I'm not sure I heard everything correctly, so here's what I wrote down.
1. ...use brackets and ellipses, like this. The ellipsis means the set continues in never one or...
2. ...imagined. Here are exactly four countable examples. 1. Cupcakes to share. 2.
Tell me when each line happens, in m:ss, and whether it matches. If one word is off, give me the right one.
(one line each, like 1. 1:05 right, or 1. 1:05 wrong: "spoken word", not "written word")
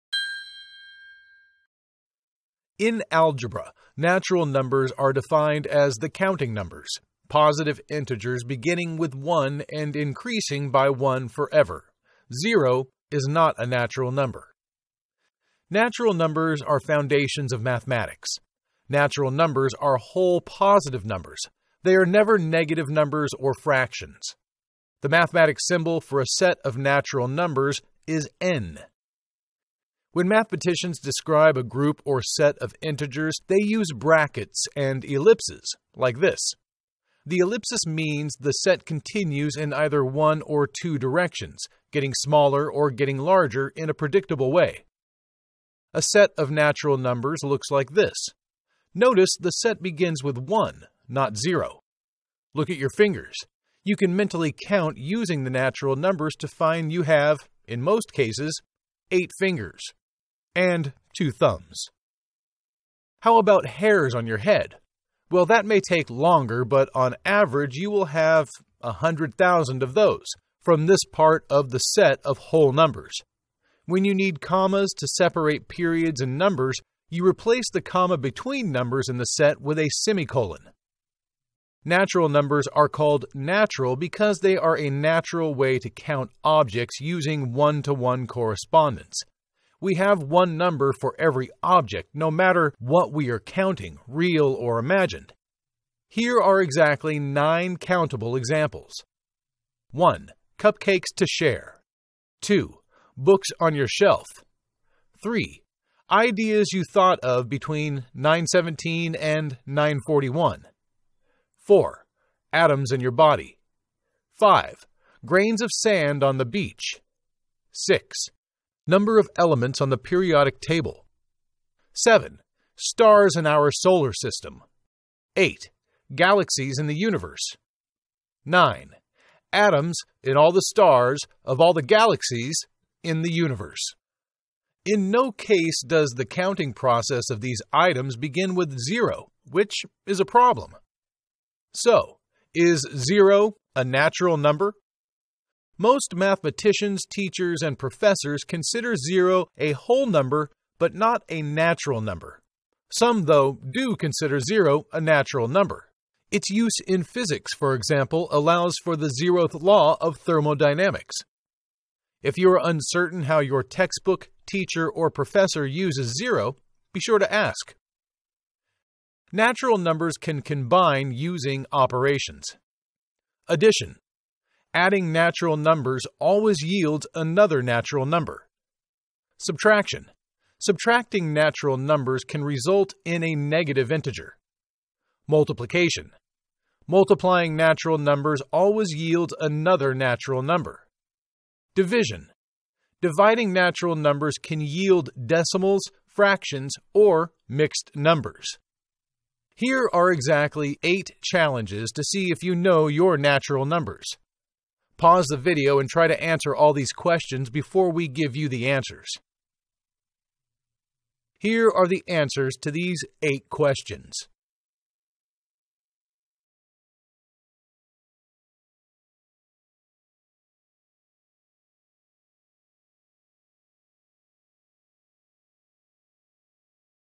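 1. 0:33 wrong: "either", not "never"
2. 1:34 wrong: "nine", not "four".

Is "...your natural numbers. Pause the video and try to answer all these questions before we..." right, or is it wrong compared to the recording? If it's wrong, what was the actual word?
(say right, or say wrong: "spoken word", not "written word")
right.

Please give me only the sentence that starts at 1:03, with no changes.
How about hairs on your head?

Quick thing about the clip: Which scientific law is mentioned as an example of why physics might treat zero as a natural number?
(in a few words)
zeroth law of thermodynamics.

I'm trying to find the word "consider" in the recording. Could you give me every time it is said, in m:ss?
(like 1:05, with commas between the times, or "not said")
2:28, 2:33.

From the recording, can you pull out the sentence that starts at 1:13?
When you need commas to separate periods and numbers, you replace the comma between numbers in the set with a semicolon.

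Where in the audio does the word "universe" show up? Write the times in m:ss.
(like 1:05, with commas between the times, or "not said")
2:06, 2:13.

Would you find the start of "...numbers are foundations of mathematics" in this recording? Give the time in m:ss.
0:16.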